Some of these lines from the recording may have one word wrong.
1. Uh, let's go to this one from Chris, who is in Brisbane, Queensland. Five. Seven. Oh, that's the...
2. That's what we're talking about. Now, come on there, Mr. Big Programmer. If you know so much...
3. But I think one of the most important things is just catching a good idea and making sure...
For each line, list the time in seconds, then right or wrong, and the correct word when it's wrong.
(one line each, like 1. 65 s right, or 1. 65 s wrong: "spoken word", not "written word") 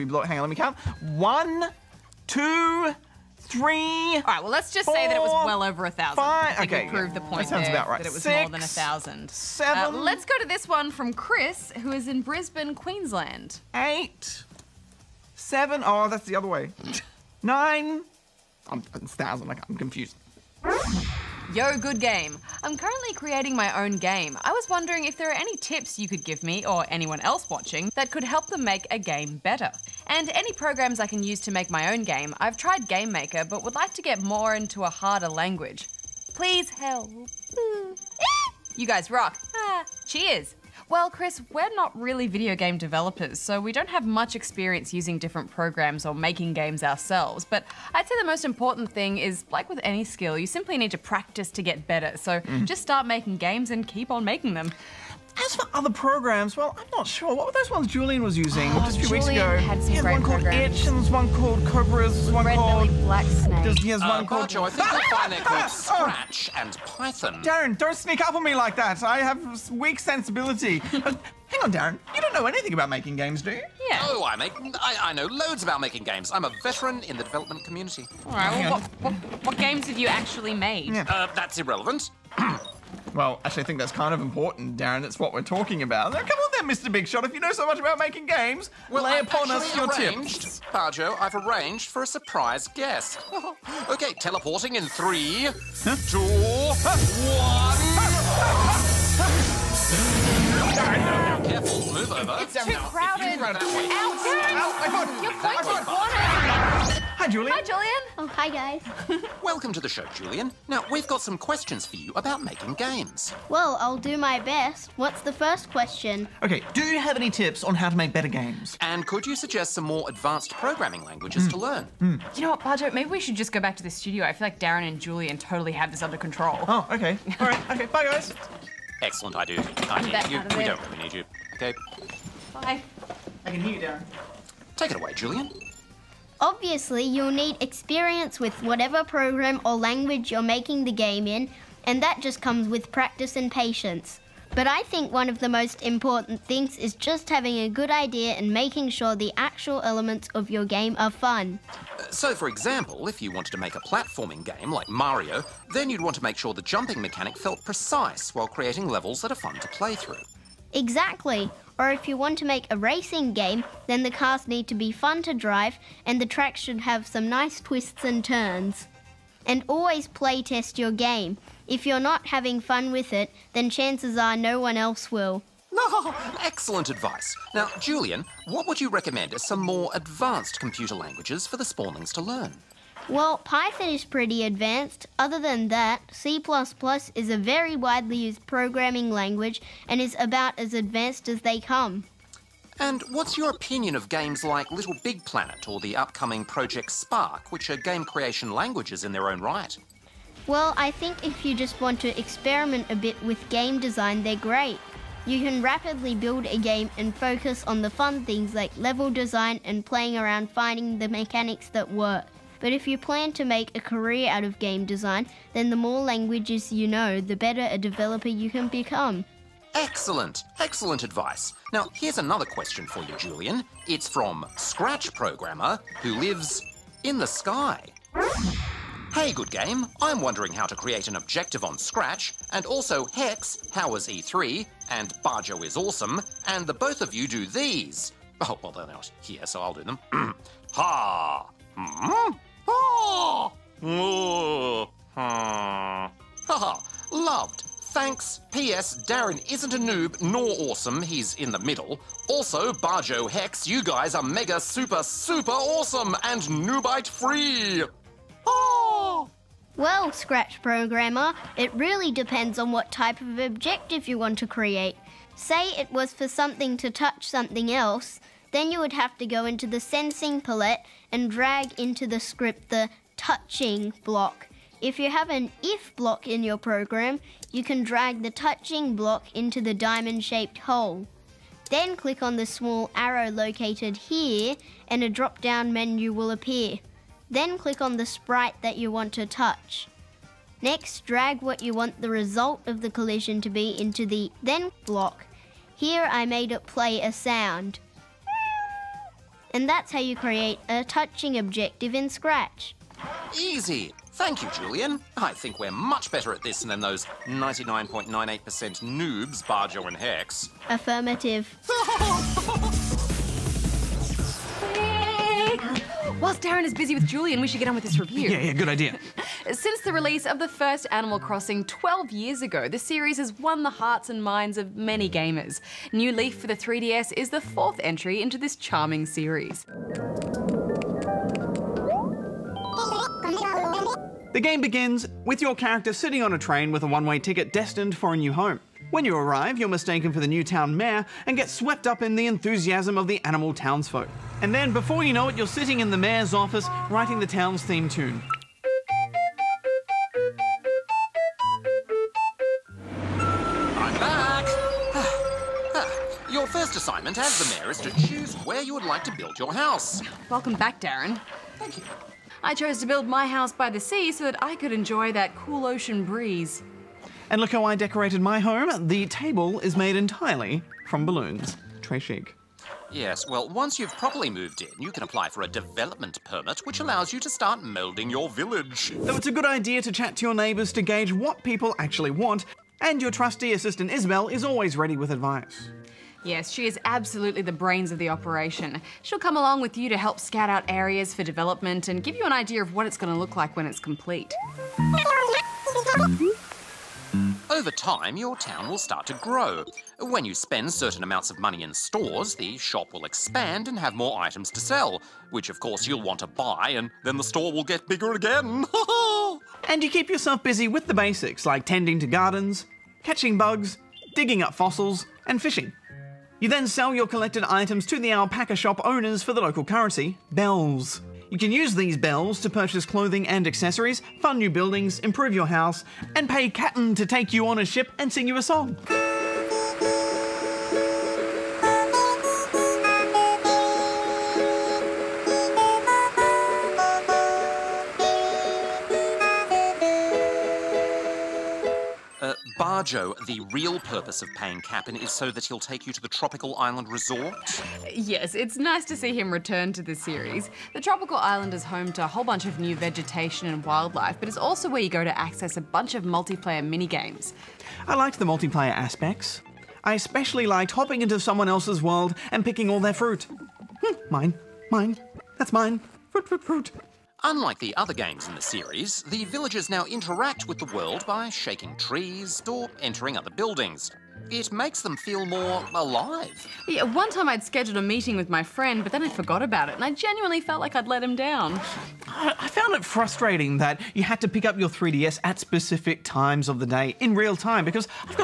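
1. 9 s wrong: "Eight", not "Five"
2. 85 s wrong: "Shot", not "Programmer"
3. 144 s wrong: "having", not "catching".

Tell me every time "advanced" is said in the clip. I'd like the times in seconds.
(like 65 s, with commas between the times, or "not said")
120 s, 179 s, 184 s, 190 s.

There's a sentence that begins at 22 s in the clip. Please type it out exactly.
I'm currently creating my own game.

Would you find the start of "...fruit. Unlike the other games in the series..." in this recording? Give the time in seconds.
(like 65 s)
466 s.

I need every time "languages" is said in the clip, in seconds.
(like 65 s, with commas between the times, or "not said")
35 s, 121 s, 139 s, 180 s, 189 s, 198 s, 216 s.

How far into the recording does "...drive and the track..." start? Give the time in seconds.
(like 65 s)
165 s.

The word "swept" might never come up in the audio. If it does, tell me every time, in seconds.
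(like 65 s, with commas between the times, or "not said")
341 s.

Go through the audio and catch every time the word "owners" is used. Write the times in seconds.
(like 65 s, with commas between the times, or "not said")
418 s.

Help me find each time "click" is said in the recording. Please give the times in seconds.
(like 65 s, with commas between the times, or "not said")
281 s, 287 s.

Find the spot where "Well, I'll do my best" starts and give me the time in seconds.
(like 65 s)
113 s.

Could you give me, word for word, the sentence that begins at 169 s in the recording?
And always play test your game.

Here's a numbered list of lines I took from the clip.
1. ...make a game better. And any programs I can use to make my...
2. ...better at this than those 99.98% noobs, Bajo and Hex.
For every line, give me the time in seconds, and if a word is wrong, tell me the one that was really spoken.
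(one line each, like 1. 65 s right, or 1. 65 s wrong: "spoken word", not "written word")
1. 28 s right
2. 306 s right.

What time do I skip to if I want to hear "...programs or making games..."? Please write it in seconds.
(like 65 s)
45 s.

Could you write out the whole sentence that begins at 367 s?
And look how I decorated my home.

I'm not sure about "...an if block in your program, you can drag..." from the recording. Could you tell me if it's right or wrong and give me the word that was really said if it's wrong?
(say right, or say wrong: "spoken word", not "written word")
right.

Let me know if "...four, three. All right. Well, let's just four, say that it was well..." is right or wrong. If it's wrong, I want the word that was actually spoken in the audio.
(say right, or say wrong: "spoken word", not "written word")
wrong: "two", not "four".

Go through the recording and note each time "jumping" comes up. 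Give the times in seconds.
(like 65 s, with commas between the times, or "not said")
156 s.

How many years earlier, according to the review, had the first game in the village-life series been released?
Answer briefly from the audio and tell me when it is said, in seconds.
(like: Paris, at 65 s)
12, at 321 s.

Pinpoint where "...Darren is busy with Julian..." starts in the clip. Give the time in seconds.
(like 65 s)
316 s.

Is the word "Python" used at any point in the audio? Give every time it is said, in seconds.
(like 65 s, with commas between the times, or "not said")
66 s, 183 s.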